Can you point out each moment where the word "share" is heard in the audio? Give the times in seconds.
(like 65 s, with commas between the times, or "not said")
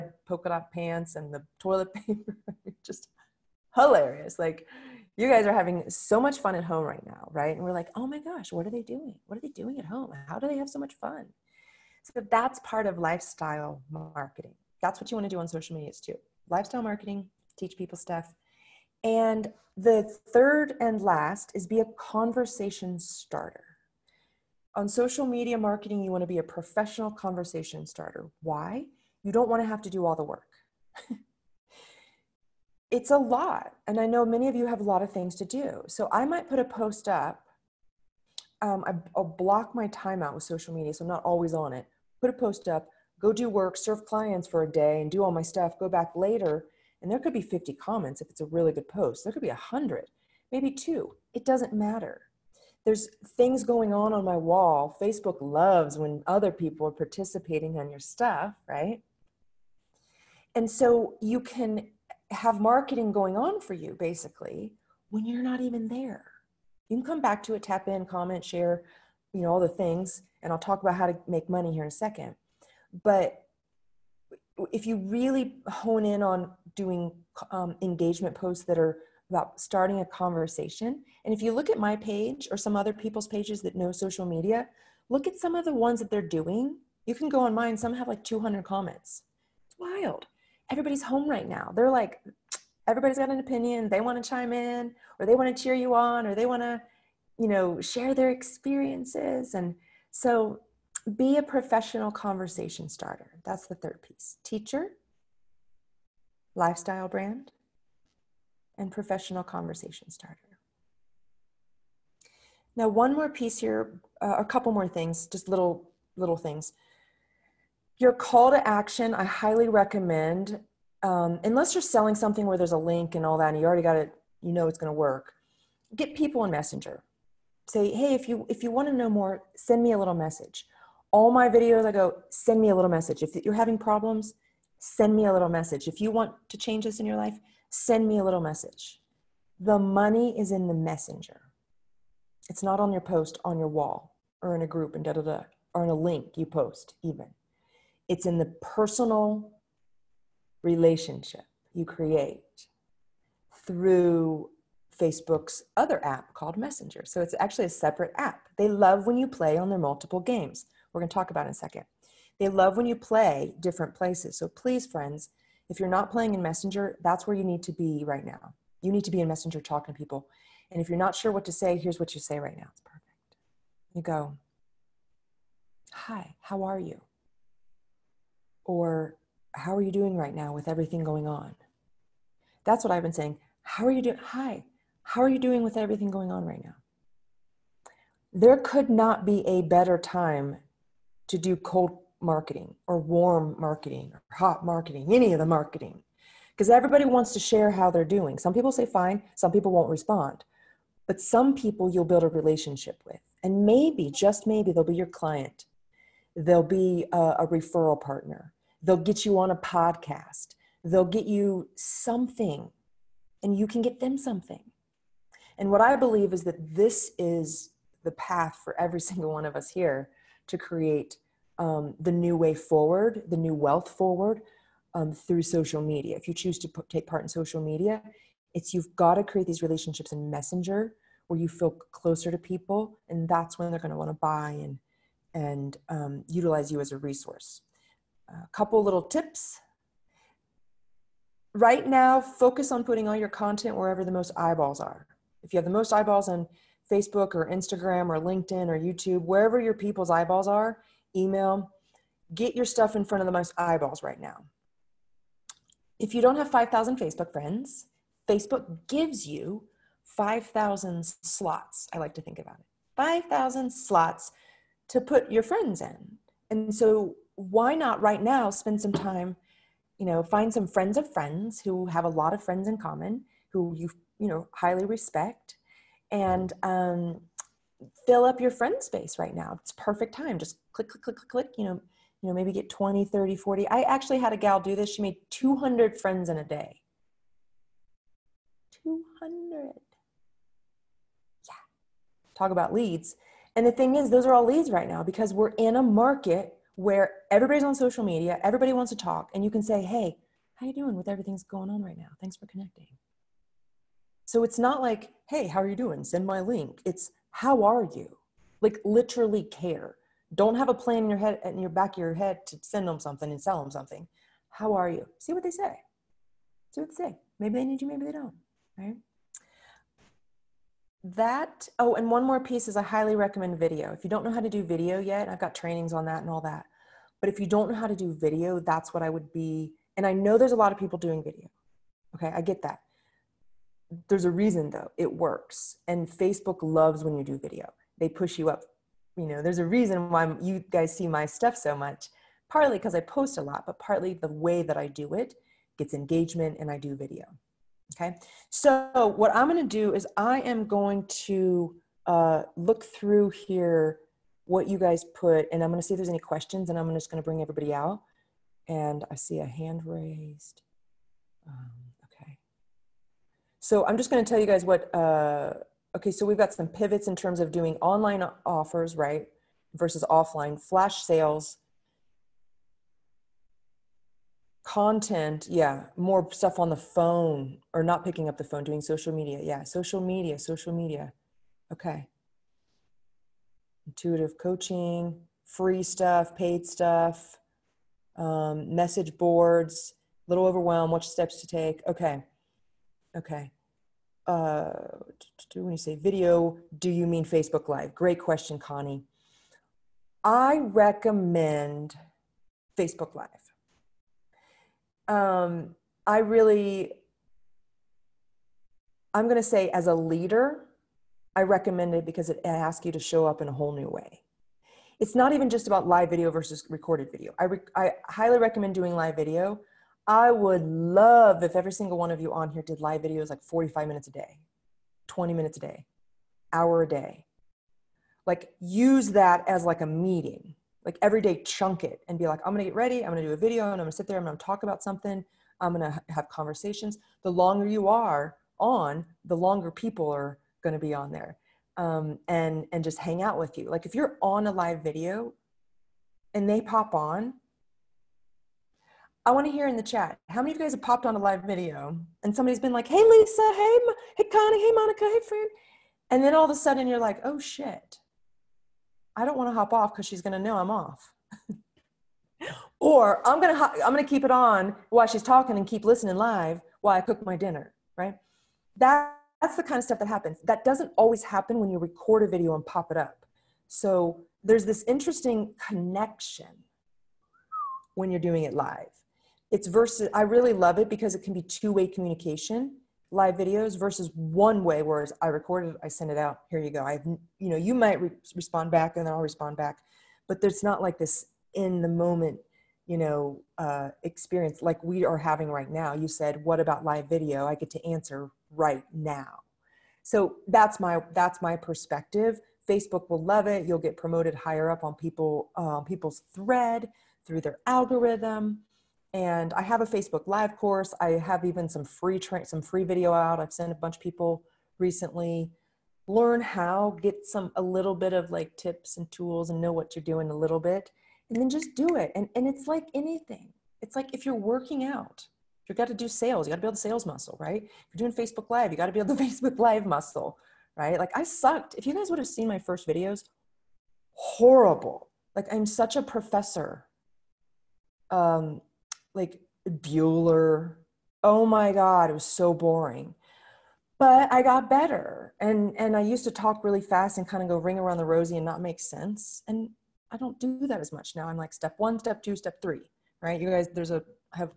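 68 s, 97 s, 197 s.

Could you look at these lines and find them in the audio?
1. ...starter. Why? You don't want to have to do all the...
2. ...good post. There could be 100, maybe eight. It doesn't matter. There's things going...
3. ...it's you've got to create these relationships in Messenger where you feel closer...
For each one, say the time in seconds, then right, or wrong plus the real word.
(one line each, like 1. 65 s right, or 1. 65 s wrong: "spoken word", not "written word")
1. 27 s right
2. 48 s wrong: "two", not "eight"
3. 228 s right.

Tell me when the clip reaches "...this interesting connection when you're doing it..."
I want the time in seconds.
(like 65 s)
474 s.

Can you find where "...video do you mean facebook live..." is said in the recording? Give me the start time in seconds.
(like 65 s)
395 s.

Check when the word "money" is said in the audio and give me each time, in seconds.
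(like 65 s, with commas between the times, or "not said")
71 s, 139 s.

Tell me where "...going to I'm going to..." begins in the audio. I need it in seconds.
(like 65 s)
463 s.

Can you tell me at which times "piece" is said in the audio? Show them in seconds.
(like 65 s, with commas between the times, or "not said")
104 s, 113 s, 322 s.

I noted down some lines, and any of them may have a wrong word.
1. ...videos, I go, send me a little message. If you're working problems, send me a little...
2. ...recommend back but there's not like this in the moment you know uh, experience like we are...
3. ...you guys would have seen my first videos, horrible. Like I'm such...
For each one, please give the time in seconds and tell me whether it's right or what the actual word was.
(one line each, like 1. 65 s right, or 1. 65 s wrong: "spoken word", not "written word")
1. 131 s wrong: "having", not "working"
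2. 489 s wrong: "respond", not "recommend"
3. 531 s right.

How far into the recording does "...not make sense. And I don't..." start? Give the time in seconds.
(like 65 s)
548 s.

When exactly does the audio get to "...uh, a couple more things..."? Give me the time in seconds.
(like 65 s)
114 s.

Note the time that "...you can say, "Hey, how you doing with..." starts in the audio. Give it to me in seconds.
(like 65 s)
299 s.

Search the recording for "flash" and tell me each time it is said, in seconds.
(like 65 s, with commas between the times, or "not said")
370 s.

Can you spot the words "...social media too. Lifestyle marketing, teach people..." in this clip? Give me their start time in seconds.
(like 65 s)
15 s.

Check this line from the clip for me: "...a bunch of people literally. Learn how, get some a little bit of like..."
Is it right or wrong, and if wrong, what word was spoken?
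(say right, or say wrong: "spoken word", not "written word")
wrong: "recently", not "literally".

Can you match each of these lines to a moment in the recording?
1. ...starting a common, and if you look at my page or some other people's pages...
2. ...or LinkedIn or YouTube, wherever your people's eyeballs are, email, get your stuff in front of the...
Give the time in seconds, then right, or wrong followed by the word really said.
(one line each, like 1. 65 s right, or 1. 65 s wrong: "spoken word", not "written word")
1. 79 s wrong: "conversation", not "common"
2. 248 s right.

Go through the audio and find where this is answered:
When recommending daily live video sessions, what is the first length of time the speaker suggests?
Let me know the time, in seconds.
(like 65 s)
423 s.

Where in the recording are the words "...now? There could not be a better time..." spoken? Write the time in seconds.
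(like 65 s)
186 s.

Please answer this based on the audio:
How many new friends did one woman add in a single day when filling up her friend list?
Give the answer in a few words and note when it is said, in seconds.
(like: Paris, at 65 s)
200, at 284 s.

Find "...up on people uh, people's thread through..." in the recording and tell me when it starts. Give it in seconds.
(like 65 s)
504 s.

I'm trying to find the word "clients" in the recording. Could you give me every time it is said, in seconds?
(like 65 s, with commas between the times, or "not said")
44 s, 205 s.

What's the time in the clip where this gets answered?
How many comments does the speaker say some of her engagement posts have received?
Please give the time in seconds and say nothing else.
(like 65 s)
87 s.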